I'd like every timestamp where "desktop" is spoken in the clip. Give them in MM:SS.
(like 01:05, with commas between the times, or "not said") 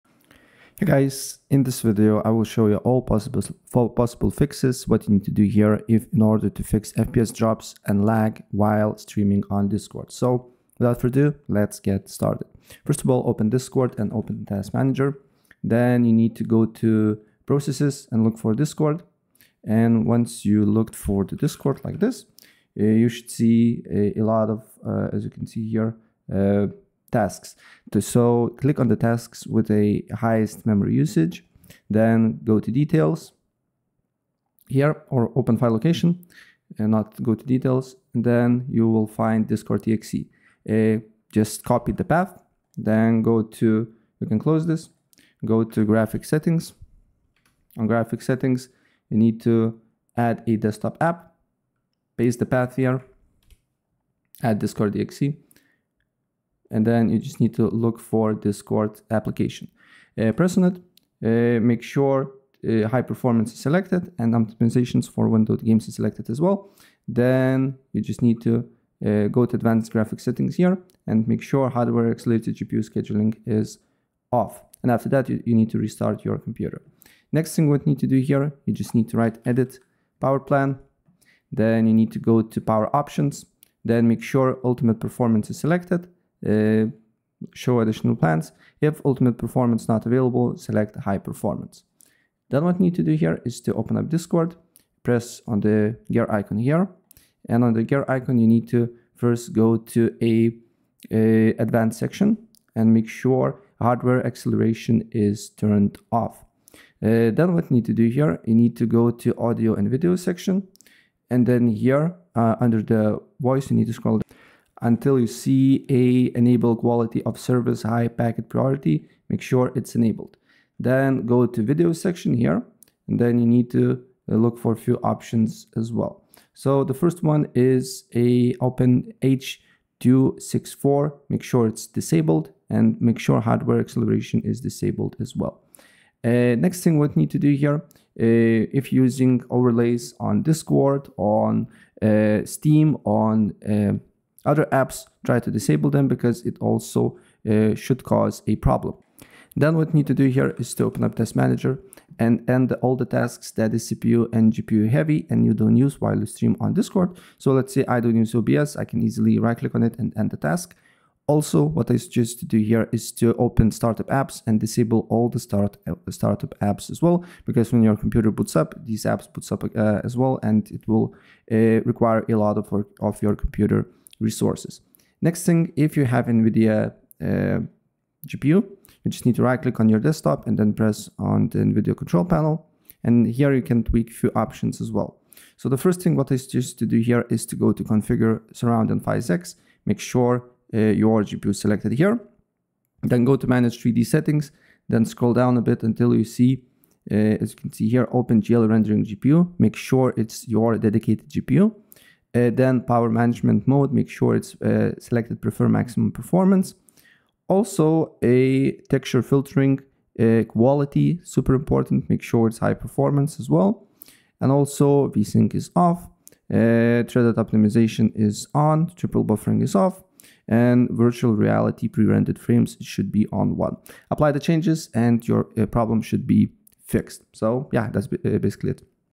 00:50, 02:59.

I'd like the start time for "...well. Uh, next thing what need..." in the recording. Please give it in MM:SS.
02:15.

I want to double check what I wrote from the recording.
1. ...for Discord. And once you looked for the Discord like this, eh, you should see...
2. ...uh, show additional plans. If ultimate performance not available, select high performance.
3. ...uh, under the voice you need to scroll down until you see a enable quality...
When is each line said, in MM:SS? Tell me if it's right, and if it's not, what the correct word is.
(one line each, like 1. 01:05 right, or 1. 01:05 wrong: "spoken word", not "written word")
1. 00:18 right
2. 01:26 right
3. 01:52 right.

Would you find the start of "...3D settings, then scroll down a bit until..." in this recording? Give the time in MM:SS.
03:13.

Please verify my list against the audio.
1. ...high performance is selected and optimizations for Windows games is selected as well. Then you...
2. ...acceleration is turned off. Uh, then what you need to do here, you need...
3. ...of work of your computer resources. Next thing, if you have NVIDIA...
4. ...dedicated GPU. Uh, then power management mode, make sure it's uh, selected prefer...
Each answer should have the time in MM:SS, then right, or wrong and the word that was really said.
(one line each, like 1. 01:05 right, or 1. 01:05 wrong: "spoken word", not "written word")
1. 01:02 right
2. 01:44 right
3. 02:52 right
4. 03:20 right.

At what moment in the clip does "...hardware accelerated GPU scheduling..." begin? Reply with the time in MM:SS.
01:11.